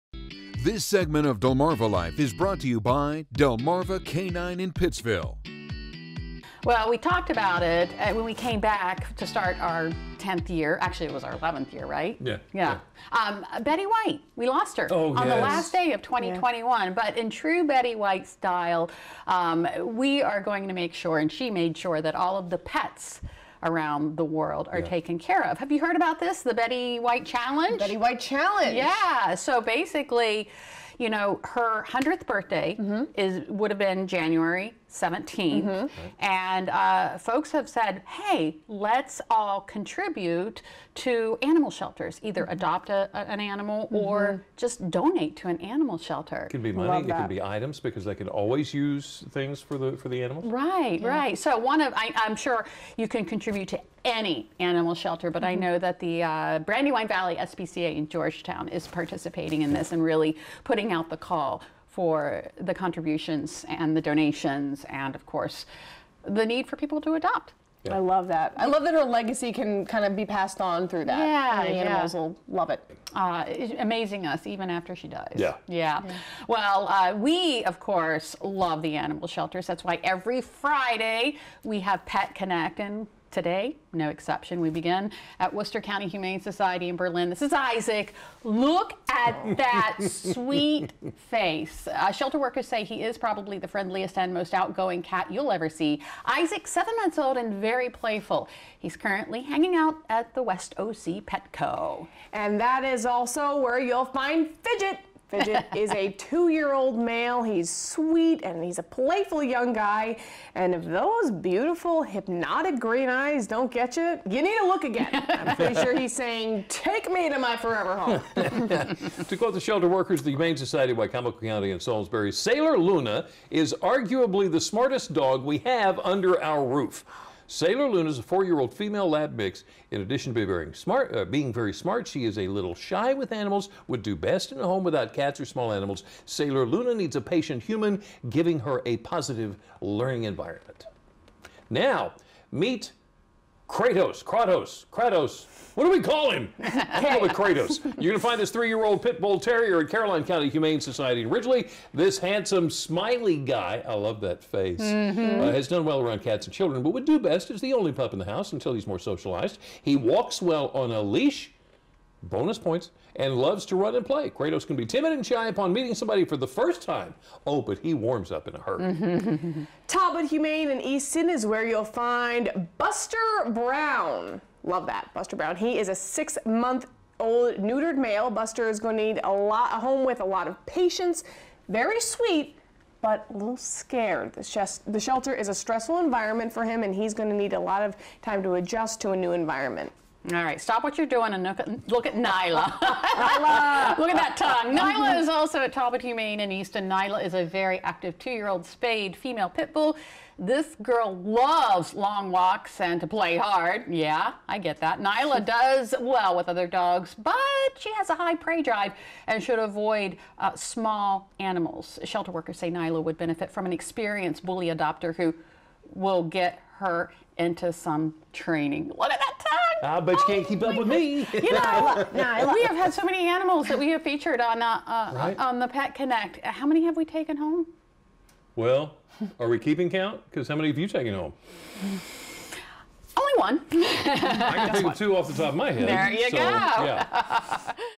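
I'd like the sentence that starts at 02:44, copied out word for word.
Kratos can be timid and shy upon meeting somebody for the first time.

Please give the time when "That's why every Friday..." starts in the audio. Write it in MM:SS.
01:19.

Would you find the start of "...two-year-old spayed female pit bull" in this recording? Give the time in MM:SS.
03:18.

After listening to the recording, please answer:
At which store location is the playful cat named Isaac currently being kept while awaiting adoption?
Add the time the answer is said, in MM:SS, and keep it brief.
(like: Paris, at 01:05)
West OC Petco, at 01:40.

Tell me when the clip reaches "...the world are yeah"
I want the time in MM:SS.
00:24.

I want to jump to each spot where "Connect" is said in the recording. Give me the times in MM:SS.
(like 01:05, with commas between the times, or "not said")
01:22, 03:45.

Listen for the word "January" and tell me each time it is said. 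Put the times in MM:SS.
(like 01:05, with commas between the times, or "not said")
00:34.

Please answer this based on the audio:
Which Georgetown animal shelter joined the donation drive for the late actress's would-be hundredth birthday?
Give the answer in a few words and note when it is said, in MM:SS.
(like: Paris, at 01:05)
Brandywine Valley SPCA, at 00:56.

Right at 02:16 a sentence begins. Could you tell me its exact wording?
Sailor Luna needs a patient human, giving her a positive learning environment.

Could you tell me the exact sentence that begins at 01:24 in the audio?
We begin at Worcester County Humane Society in Berlin.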